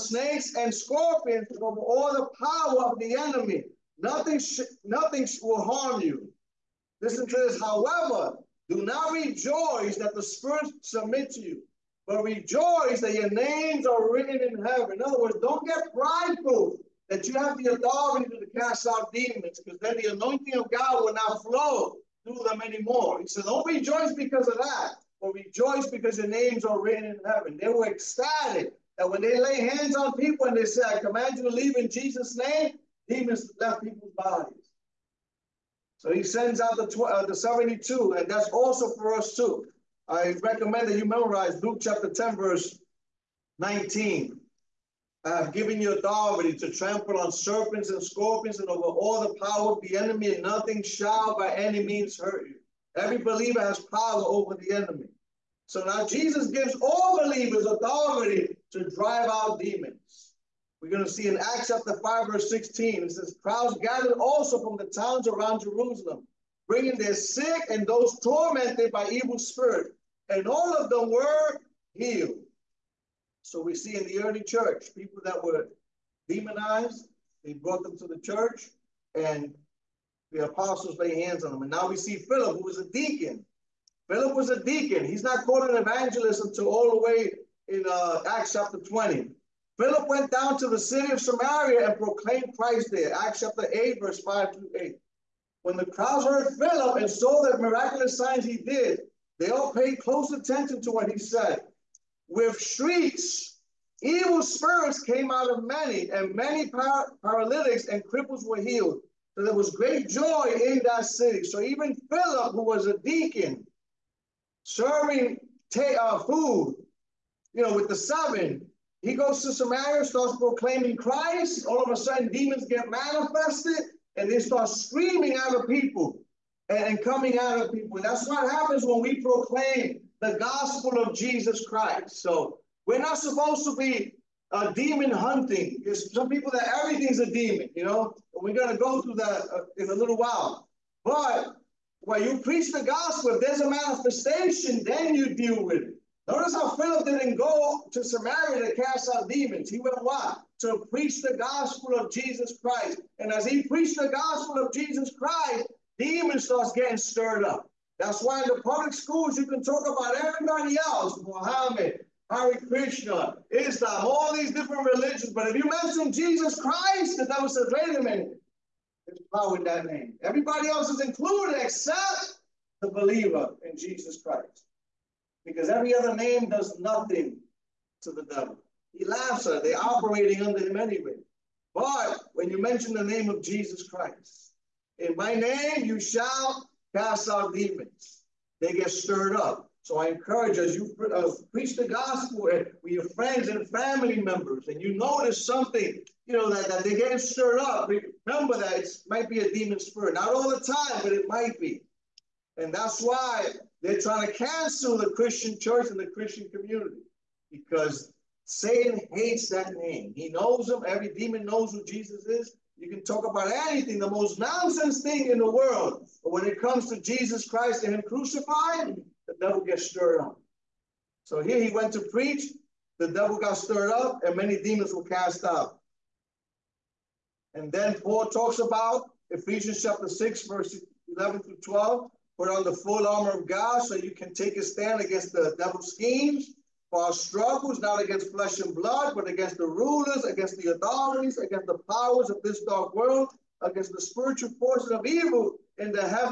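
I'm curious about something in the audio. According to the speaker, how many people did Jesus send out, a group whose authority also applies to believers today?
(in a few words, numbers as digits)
72.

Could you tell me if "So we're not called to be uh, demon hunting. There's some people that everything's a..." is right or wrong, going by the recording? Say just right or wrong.
wrong.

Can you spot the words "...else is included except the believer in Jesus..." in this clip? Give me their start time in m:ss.
2:50.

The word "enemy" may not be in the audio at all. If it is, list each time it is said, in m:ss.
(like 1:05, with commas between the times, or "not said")
0:03, 0:49, 0:54.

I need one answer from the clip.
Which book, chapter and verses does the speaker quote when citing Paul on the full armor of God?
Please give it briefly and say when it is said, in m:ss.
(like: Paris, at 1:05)
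Ephesians 6:11-12, at 3:49.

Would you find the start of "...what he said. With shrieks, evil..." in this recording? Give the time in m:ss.
1:40.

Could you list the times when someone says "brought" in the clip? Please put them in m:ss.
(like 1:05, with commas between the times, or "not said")
1:17.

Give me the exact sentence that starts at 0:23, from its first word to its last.
He said, Don't rejoice because of that, but rejoice because your names are written in heaven.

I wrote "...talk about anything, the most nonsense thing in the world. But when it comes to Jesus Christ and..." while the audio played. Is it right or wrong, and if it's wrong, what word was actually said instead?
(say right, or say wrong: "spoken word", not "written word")
right.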